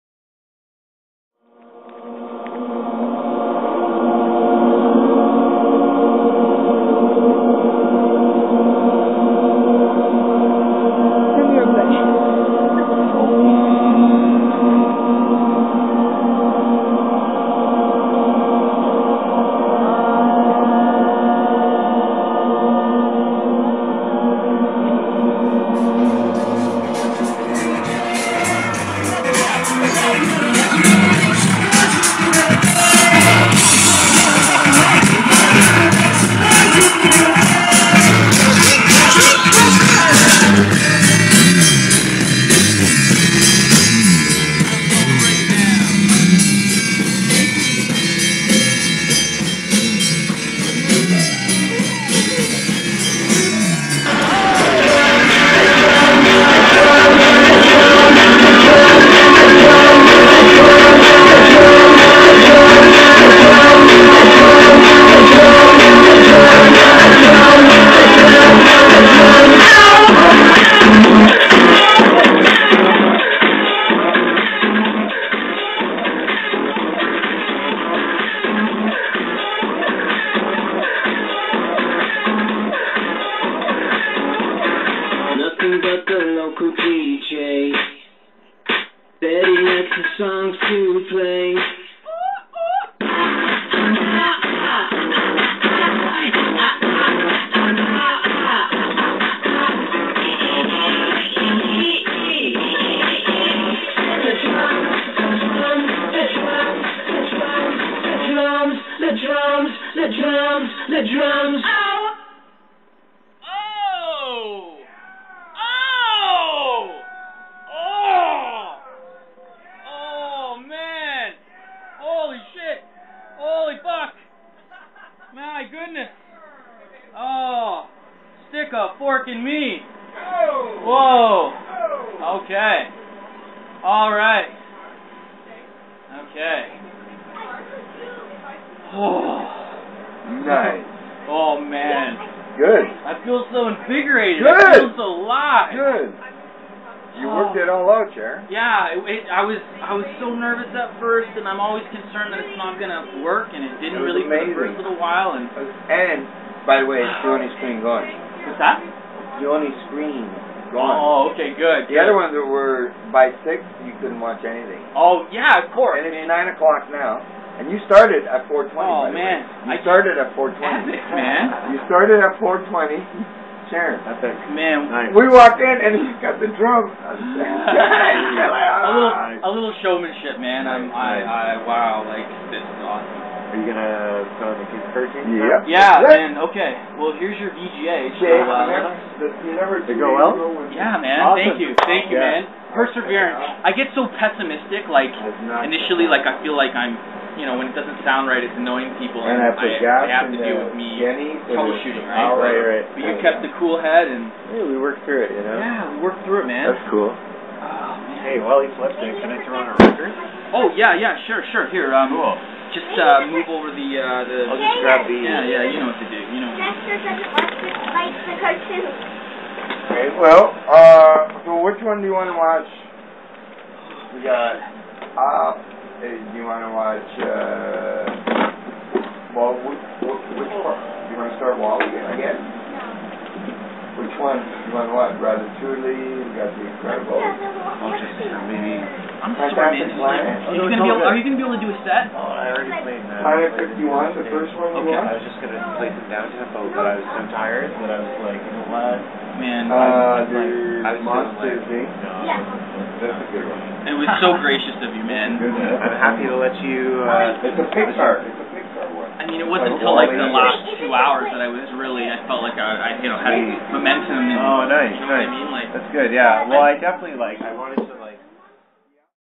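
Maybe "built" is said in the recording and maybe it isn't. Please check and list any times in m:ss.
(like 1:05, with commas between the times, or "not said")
not said.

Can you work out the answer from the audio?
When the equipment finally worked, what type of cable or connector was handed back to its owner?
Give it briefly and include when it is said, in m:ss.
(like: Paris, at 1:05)
VGA, at 3:07.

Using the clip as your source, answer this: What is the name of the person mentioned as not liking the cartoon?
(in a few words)
Dexter.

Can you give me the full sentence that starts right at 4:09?
Man, uh, I, was I was Monster like, Inc.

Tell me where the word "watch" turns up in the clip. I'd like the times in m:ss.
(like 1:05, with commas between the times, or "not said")
2:44, 3:42, 3:46, 3:54.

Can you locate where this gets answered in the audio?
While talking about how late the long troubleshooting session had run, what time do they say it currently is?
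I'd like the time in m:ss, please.
2:46.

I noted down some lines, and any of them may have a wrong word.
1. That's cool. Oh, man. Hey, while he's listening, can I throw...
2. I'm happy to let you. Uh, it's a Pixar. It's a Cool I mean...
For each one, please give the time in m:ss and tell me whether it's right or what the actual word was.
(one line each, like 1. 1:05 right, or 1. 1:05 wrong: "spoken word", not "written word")
1. 3:26 right
2. 4:15 wrong: "Pixar", not "Cool".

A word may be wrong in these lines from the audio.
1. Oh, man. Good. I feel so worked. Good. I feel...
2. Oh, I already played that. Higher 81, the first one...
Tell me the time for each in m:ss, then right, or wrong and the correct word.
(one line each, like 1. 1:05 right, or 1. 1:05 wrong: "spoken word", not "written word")
1. 2:21 wrong: "invigorated", not "worked"
2. 4:02 wrong: "51", not "81".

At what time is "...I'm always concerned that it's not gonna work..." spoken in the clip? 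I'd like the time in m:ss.
2:31.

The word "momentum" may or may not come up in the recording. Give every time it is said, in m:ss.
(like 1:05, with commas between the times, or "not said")
4:23.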